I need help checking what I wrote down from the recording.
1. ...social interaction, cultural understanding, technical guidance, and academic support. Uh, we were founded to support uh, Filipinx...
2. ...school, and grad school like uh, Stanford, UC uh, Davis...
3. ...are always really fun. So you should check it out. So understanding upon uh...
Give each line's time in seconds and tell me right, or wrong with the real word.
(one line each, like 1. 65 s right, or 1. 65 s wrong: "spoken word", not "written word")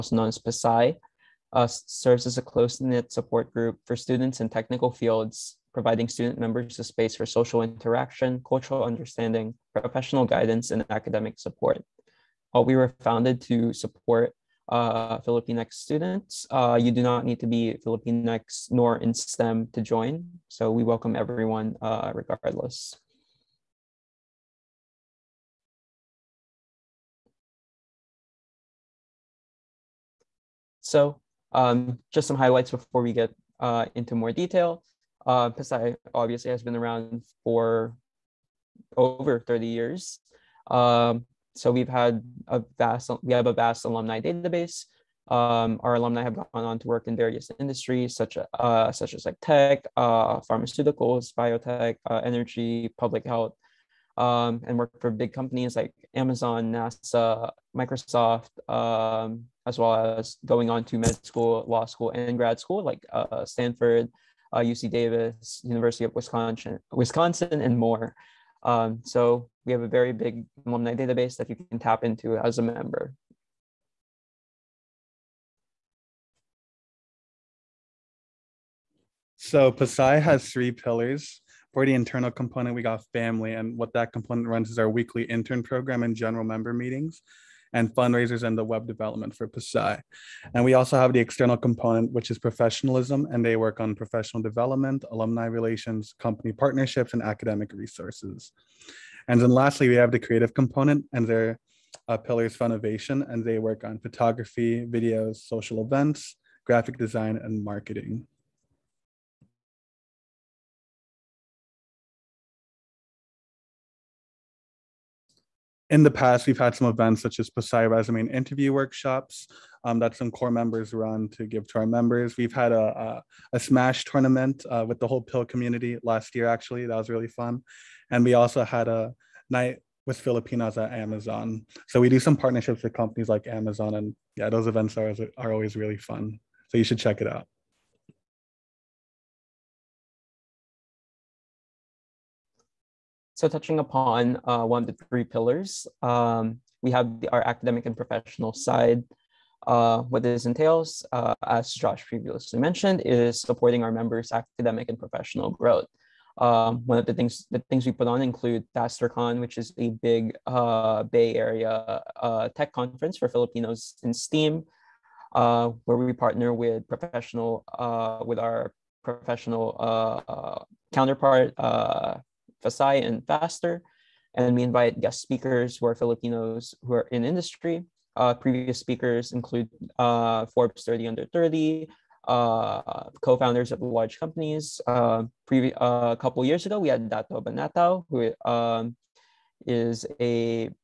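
1. 7 s wrong: "professional", not "technical"
2. 61 s right
3. 135 s wrong: "touching", not "understanding".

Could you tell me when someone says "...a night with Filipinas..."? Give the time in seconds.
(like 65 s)
128 s.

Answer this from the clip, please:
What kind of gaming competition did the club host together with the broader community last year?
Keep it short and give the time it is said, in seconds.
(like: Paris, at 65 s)
Smash tournament, at 123 s.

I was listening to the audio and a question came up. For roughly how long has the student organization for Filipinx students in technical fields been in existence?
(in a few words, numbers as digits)
over 30 years.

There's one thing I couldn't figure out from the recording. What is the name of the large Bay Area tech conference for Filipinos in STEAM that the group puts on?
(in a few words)
TasterCon.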